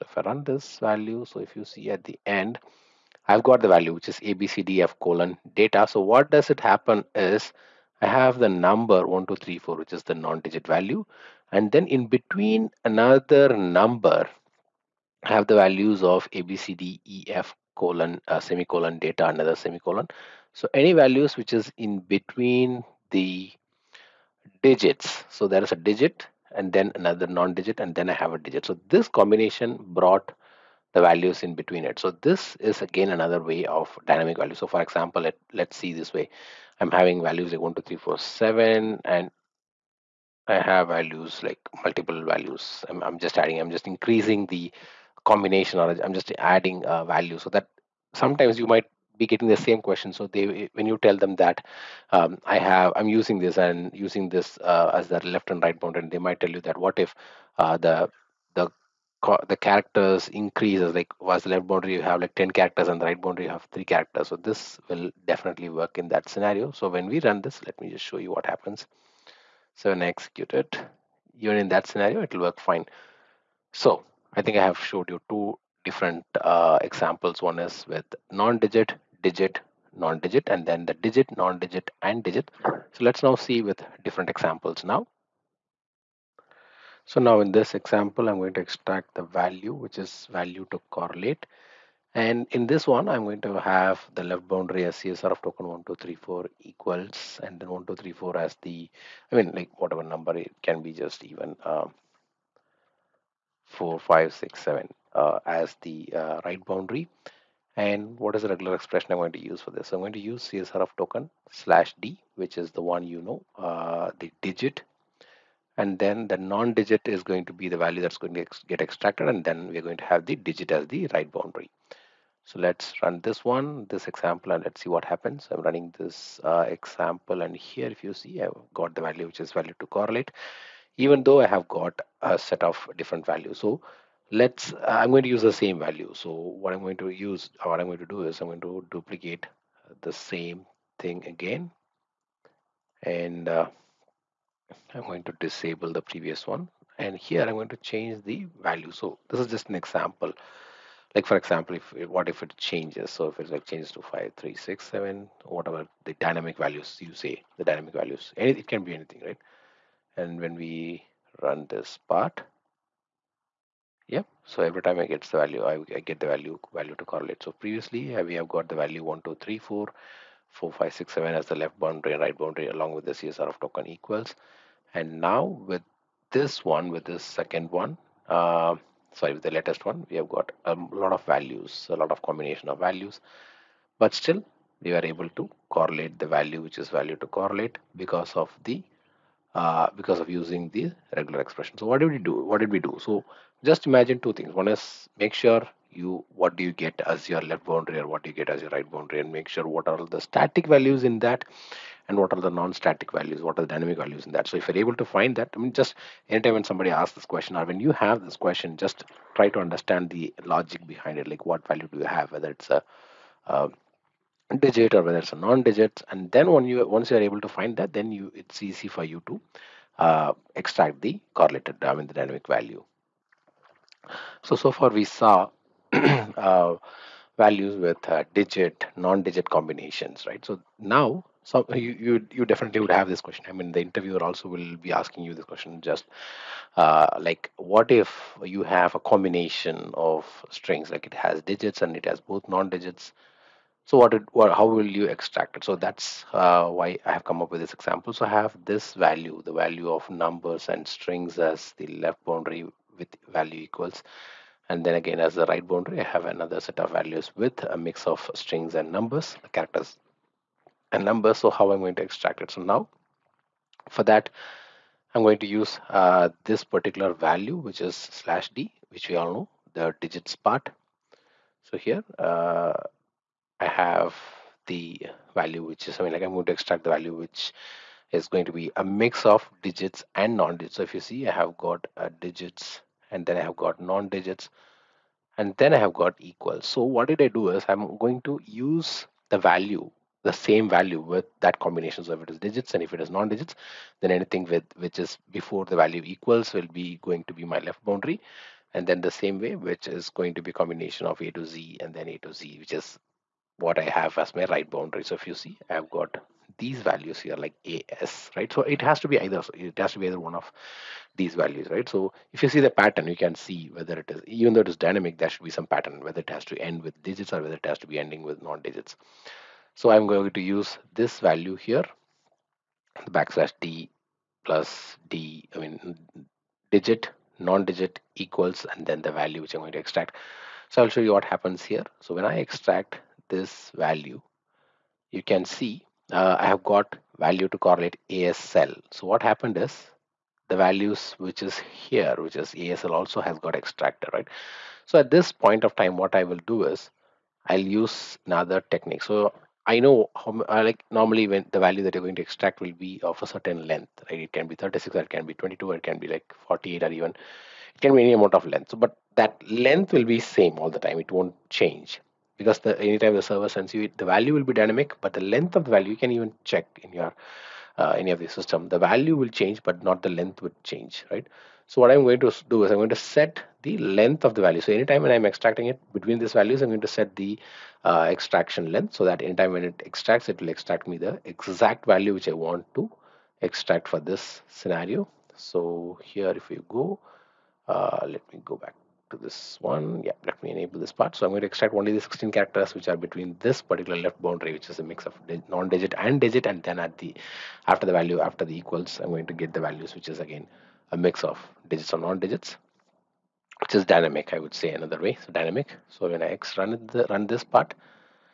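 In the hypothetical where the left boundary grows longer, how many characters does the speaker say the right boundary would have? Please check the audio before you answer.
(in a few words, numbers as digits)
3.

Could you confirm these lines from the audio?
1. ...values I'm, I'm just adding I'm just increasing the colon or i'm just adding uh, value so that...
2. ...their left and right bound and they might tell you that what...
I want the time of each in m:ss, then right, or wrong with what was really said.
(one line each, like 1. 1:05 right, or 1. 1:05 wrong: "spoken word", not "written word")
1. 0:42 wrong: "combination", not "colon"
2. 0:55 right.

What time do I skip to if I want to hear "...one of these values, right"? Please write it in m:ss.
5:10.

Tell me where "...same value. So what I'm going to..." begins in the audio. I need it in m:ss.
2:15.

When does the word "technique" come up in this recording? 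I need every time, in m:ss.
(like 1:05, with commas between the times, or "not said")
5:48.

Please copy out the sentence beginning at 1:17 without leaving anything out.
One is with non-digit, digit, non-digit, non and then the digit, non-digit, and digit.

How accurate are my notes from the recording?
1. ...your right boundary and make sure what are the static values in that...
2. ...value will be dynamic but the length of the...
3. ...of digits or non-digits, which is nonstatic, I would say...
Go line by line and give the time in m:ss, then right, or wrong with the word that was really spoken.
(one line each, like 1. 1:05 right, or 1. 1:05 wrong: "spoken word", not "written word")
1. 3:18 right
2. 6:04 right
3. 6:41 wrong: "dynamic", not "nonstatic".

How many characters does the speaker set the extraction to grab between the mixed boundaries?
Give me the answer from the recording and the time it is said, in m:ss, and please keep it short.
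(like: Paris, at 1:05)
16, at 6:32.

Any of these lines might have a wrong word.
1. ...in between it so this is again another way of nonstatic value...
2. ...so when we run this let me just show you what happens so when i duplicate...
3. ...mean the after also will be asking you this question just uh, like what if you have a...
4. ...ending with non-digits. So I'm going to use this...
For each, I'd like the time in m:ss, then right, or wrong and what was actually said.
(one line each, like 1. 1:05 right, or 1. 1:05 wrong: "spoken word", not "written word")
1. 0:31 wrong: "dynamic", not "nonstatic"
2. 1:06 wrong: "execute", not "duplicate"
3. 3:53 wrong: "interviewer", not "after"
4. 5:17 right.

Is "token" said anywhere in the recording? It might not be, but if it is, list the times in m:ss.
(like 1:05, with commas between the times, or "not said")
1:35, 1:50, 2:53.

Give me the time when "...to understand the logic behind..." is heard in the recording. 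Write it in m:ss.
3:29.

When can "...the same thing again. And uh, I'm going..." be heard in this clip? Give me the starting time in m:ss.
2:20.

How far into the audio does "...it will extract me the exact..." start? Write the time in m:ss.
6:20.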